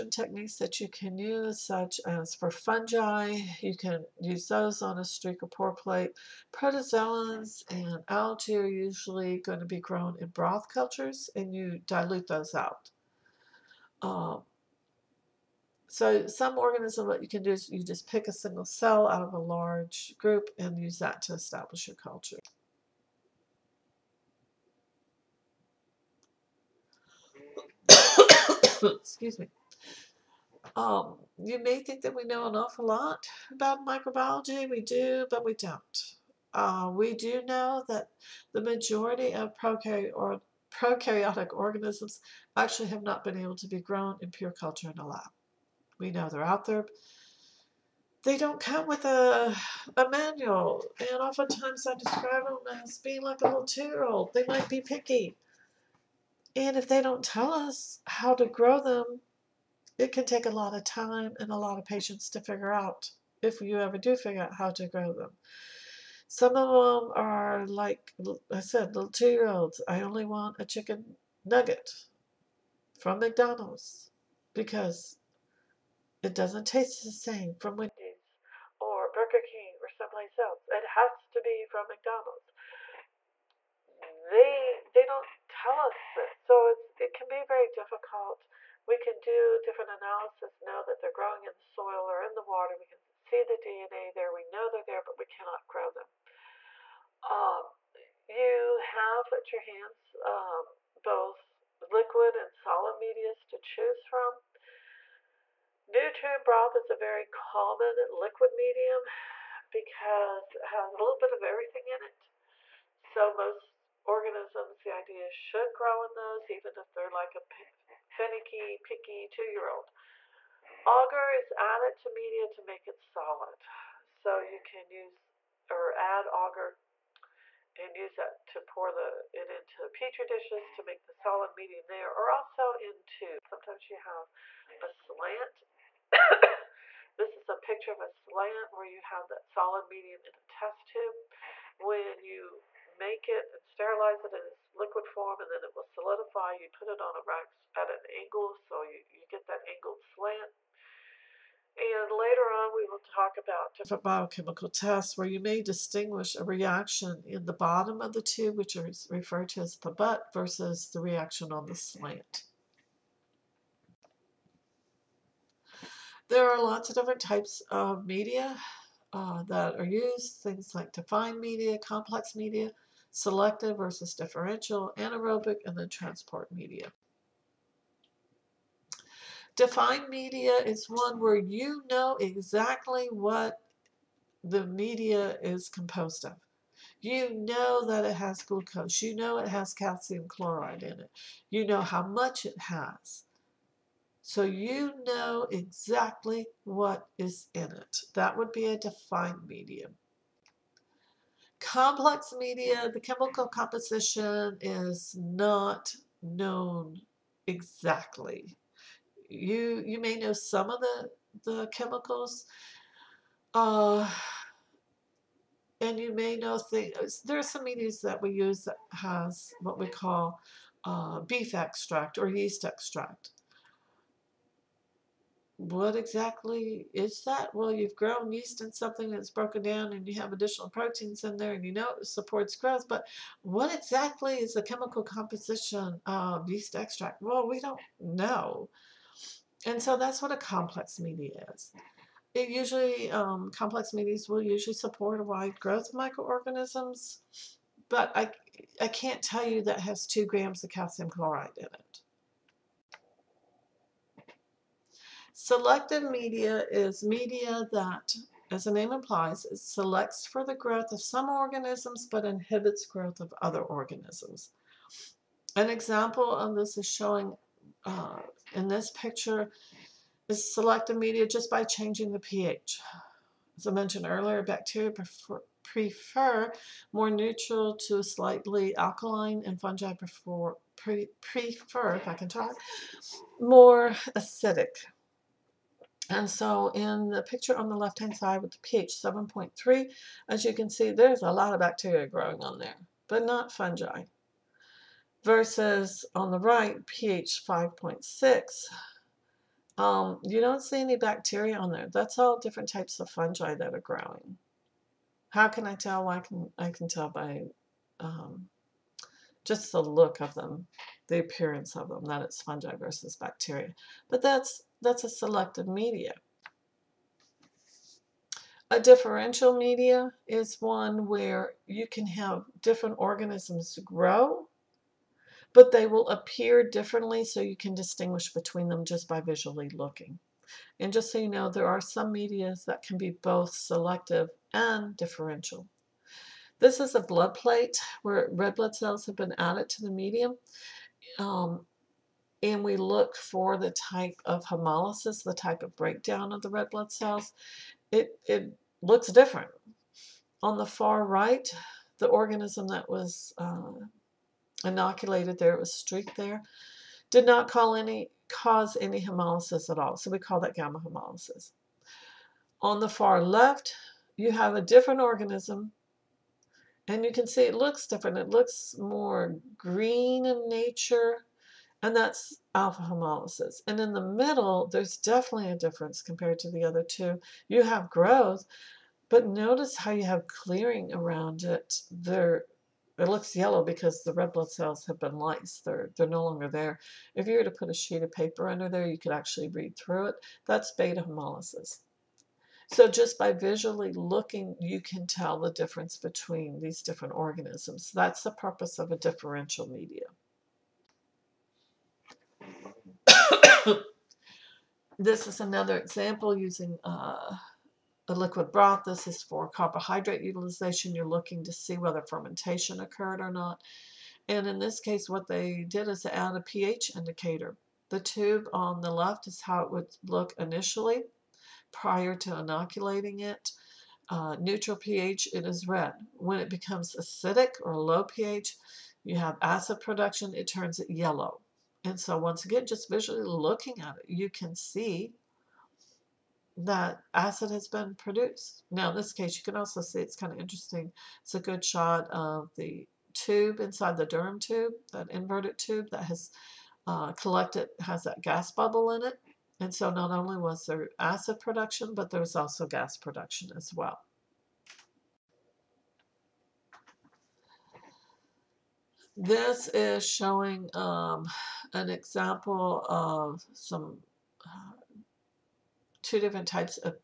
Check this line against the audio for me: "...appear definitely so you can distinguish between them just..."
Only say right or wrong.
wrong.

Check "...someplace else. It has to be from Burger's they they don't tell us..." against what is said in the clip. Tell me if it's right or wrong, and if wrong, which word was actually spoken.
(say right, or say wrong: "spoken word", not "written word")
wrong: "McDonald", not "Burger".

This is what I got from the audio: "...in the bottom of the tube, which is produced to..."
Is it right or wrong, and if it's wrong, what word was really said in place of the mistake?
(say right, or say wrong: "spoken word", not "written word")
wrong: "referred", not "produced".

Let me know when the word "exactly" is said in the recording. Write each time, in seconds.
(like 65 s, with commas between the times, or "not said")
182 s, 195 s, 207 s, 225 s, 233 s.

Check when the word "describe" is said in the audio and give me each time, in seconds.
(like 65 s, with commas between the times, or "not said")
51 s.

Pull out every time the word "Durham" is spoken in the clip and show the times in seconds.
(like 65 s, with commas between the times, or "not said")
444 s.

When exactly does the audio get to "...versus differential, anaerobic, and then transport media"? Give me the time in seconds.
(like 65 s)
173 s.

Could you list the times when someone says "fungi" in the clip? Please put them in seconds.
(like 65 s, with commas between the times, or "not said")
2 s, 279 s, 293 s, 303 s, 312 s.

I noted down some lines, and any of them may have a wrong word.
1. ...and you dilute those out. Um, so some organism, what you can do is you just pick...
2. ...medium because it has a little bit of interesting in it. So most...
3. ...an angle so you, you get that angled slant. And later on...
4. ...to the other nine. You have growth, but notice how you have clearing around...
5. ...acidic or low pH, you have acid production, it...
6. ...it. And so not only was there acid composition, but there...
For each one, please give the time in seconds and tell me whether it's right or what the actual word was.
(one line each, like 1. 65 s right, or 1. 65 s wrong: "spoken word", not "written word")
1. 11 s right
2. 108 s wrong: "everything", not "interesting"
3. 147 s right
4. 376 s wrong: "two", not "nine"
5. 426 s right
6. 449 s wrong: "production", not "composition".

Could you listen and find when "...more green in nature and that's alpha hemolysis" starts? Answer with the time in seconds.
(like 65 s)
368 s.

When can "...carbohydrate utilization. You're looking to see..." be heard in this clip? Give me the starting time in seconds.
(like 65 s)
409 s.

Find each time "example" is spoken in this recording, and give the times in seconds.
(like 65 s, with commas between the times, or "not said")
265 s, 405 s, 461 s.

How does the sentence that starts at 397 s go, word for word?
That's the purpose of a differential media.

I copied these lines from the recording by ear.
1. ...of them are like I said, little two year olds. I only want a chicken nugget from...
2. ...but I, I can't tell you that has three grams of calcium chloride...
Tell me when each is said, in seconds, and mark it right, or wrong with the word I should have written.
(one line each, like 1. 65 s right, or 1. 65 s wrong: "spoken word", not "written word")
1. 66 s right
2. 247 s wrong: "two", not "three".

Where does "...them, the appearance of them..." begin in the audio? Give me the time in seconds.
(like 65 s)
310 s.